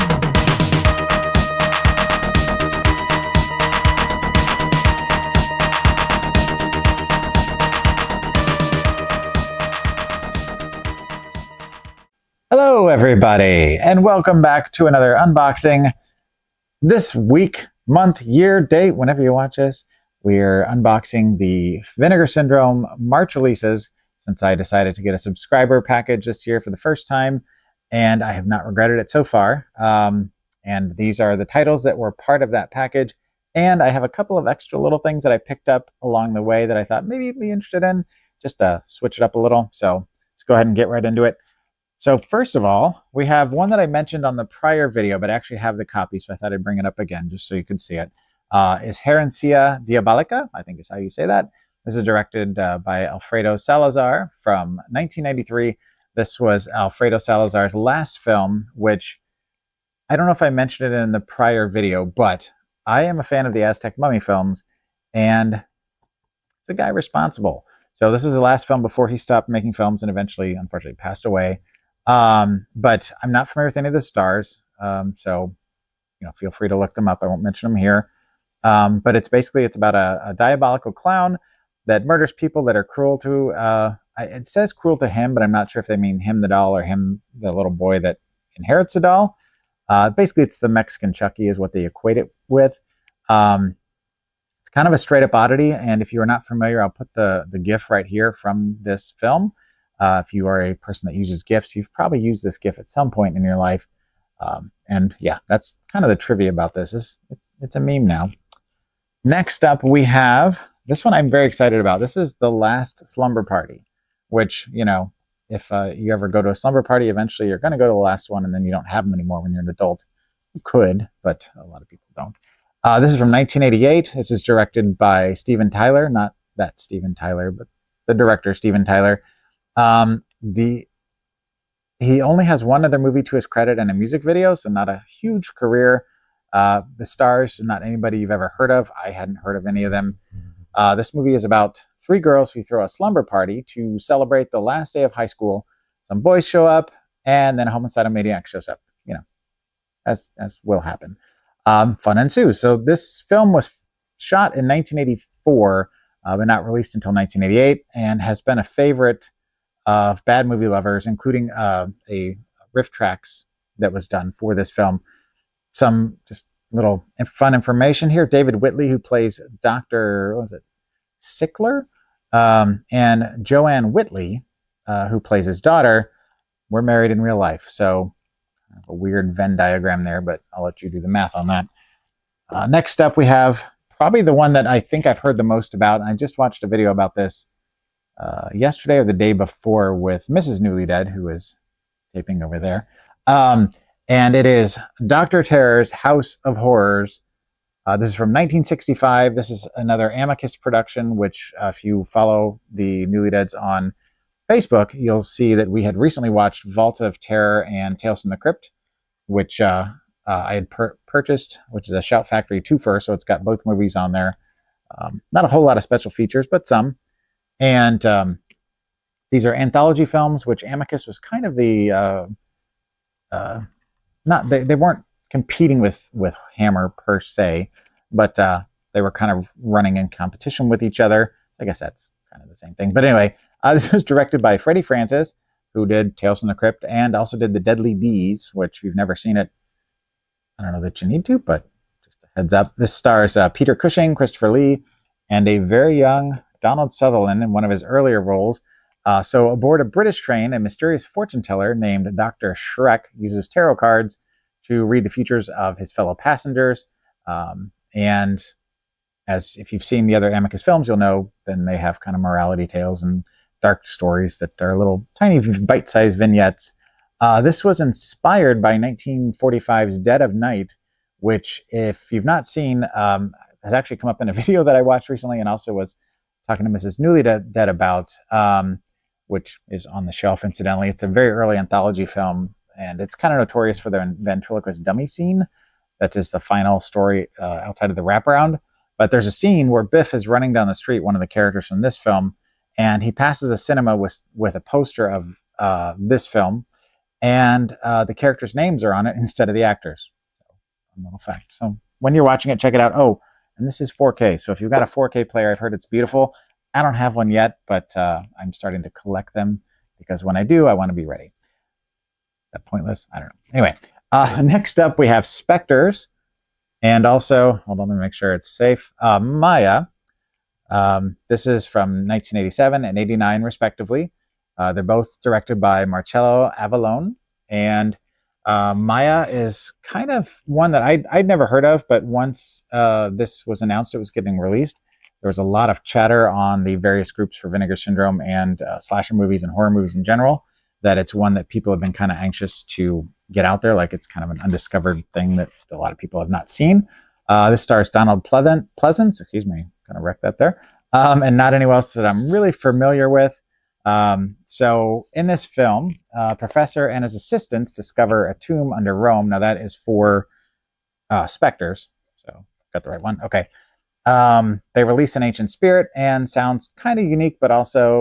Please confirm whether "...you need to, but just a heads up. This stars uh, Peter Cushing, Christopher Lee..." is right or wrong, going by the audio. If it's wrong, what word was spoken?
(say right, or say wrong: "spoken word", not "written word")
right.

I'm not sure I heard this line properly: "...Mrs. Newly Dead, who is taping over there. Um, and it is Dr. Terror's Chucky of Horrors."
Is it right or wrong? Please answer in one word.
wrong.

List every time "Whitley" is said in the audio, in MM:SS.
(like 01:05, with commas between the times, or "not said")
02:48, 02:53.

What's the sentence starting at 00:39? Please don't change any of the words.
So let's go ahead and get right into it.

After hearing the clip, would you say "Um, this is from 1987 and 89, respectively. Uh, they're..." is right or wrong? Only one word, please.
right.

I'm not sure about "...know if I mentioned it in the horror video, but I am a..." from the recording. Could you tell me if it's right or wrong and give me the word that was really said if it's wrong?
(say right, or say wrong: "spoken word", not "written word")
wrong: "prior", not "horror".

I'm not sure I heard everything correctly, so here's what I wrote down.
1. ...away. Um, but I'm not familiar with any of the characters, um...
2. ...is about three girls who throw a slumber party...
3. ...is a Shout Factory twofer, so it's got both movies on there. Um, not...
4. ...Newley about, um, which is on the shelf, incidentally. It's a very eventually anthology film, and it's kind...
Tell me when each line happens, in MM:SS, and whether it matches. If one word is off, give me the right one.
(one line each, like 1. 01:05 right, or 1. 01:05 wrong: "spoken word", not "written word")
1. 01:11 wrong: "stars", not "characters"
2. 02:21 right
3. 03:31 right
4. 04:36 wrong: "early", not "eventually".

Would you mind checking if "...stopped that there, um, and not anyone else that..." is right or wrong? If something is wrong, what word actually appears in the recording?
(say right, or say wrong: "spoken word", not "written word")
wrong: "wrecked", not "stopped".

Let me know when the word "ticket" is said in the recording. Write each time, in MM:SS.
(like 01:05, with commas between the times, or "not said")
not said.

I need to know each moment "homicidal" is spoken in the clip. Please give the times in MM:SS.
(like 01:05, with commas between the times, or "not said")
02:27.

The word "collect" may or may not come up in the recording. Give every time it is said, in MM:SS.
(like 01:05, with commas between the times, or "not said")
05:08.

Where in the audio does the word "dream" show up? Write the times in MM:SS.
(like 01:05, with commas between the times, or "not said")
not said.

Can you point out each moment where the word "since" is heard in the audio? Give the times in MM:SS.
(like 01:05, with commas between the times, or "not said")
00:24.